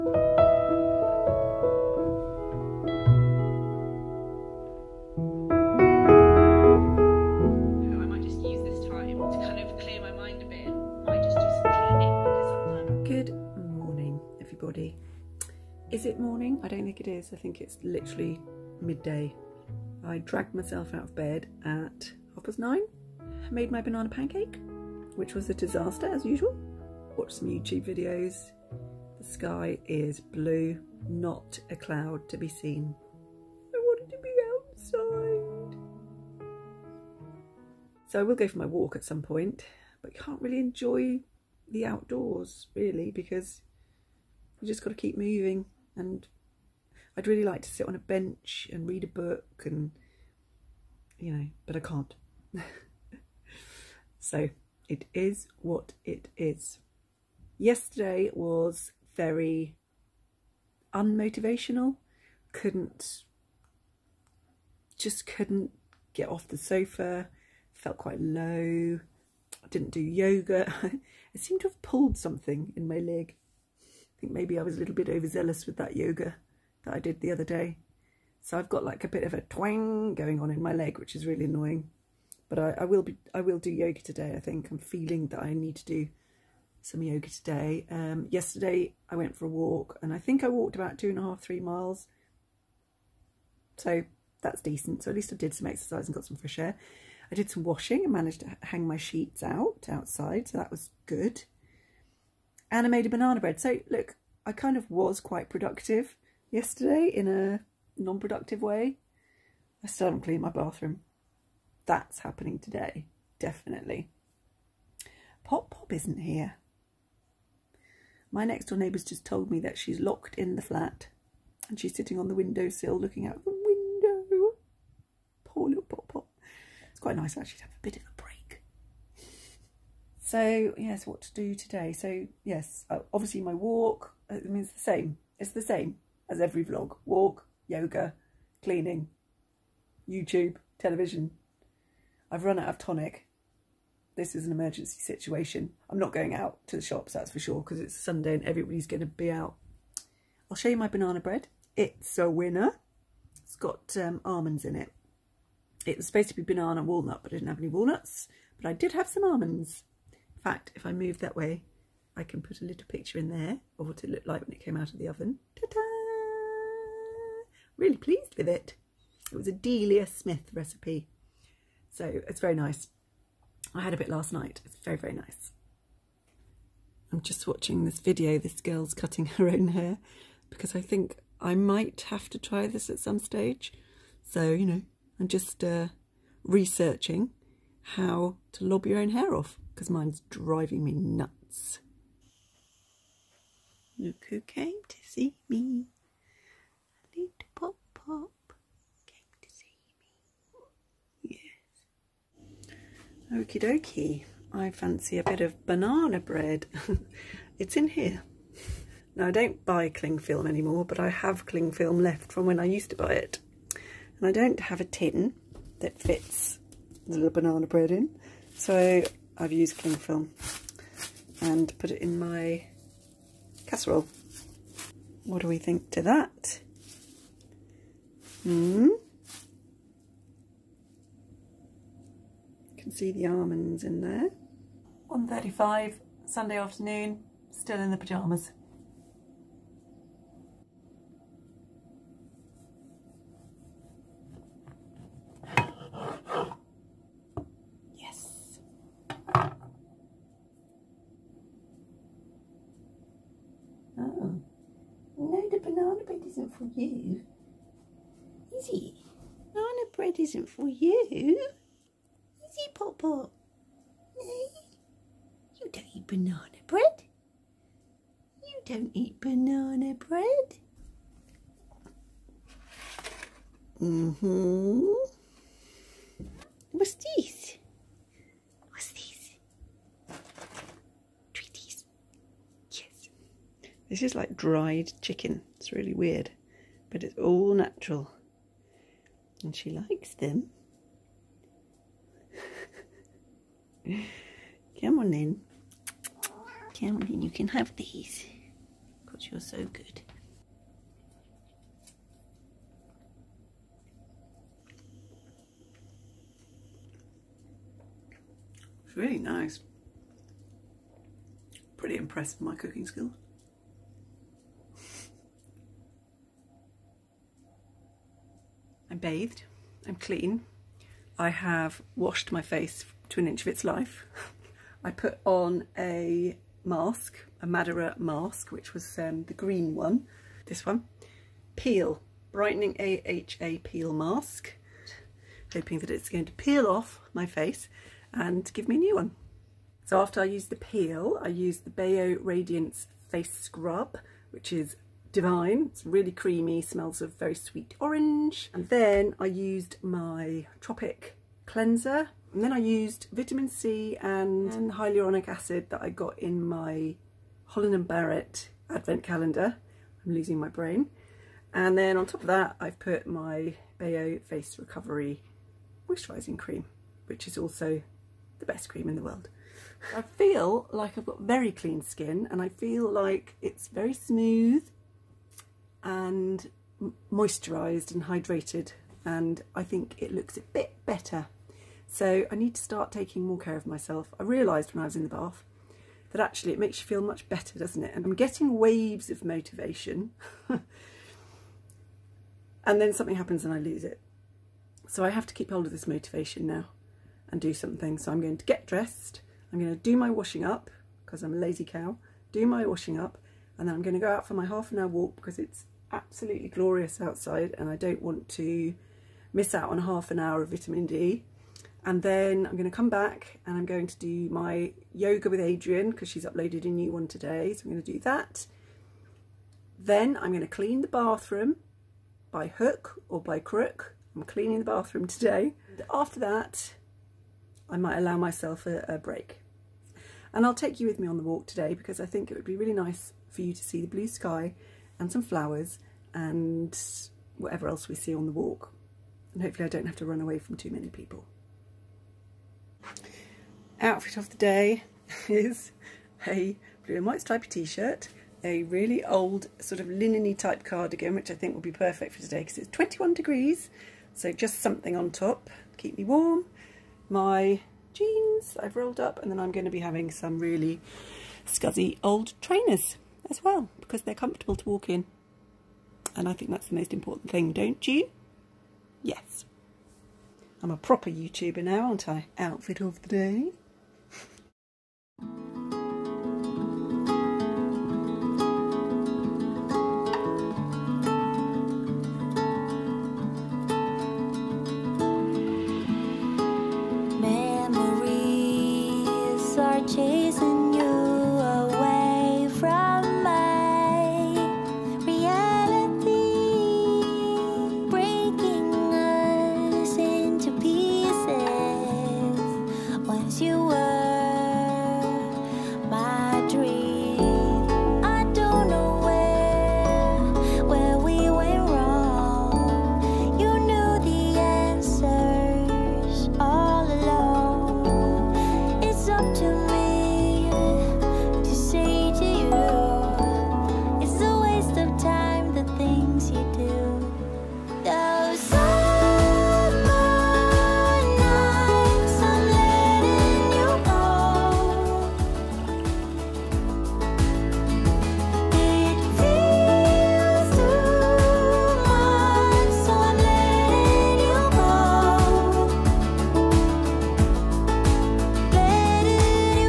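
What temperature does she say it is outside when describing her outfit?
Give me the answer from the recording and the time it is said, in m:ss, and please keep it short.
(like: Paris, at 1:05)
21 degrees, at 7:32.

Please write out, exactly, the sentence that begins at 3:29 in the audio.
Now, I don't buy cling film anymore, but I have cling film left from when I used to buy it.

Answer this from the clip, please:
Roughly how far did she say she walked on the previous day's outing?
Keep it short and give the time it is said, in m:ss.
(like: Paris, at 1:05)
two and a half, three miles, at 1:30.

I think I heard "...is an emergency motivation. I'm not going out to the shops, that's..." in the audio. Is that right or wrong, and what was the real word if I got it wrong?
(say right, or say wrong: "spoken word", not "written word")
wrong: "situation", not "motivation".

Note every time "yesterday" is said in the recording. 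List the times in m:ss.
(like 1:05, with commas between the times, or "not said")
0:57, 1:28, 1:46.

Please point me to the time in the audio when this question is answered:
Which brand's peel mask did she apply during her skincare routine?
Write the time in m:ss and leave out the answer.
5:27.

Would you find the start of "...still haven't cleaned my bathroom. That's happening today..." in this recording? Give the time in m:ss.
1:49.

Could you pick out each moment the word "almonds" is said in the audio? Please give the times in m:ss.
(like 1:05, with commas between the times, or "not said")
2:34, 2:39, 3:53.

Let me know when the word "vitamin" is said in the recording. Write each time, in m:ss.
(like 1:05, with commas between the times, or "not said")
5:53, 6:50.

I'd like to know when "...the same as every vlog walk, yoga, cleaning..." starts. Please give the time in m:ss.
2:15.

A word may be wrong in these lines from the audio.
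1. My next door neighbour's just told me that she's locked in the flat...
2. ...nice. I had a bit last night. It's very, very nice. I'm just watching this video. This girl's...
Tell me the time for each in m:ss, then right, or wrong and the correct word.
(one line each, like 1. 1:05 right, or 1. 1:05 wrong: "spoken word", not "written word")
1. 1:58 right
2. 2:52 right.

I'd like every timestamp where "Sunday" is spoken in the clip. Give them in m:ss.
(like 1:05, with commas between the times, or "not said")
2:27, 3:56.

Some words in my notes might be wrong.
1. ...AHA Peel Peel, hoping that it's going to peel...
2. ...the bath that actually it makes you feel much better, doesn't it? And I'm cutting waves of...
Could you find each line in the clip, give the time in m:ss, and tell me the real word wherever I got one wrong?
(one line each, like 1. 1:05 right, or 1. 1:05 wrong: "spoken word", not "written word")
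1. 5:32 wrong: "Mask", not "Peel"
2. 6:25 wrong: "getting", not "cutting".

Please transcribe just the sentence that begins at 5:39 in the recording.
So after I use the peel, I use the Bayo Radiance Face Scrub, which is divine.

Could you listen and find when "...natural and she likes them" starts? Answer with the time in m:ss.
4:47.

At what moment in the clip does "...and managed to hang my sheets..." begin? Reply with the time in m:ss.
1:38.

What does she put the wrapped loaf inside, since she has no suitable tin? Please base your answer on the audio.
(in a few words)
casserole.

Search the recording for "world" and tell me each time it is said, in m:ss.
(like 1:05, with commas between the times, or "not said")
6:09.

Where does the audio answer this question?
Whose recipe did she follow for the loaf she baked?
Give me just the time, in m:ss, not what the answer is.
2:49.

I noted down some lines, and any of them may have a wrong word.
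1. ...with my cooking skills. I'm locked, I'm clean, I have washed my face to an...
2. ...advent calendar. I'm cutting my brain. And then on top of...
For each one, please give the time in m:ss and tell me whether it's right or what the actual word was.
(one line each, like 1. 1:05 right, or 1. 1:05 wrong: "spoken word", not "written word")
1. 5:12 wrong: "bathed", not "locked"
2. 5:58 wrong: "losing", not "cutting".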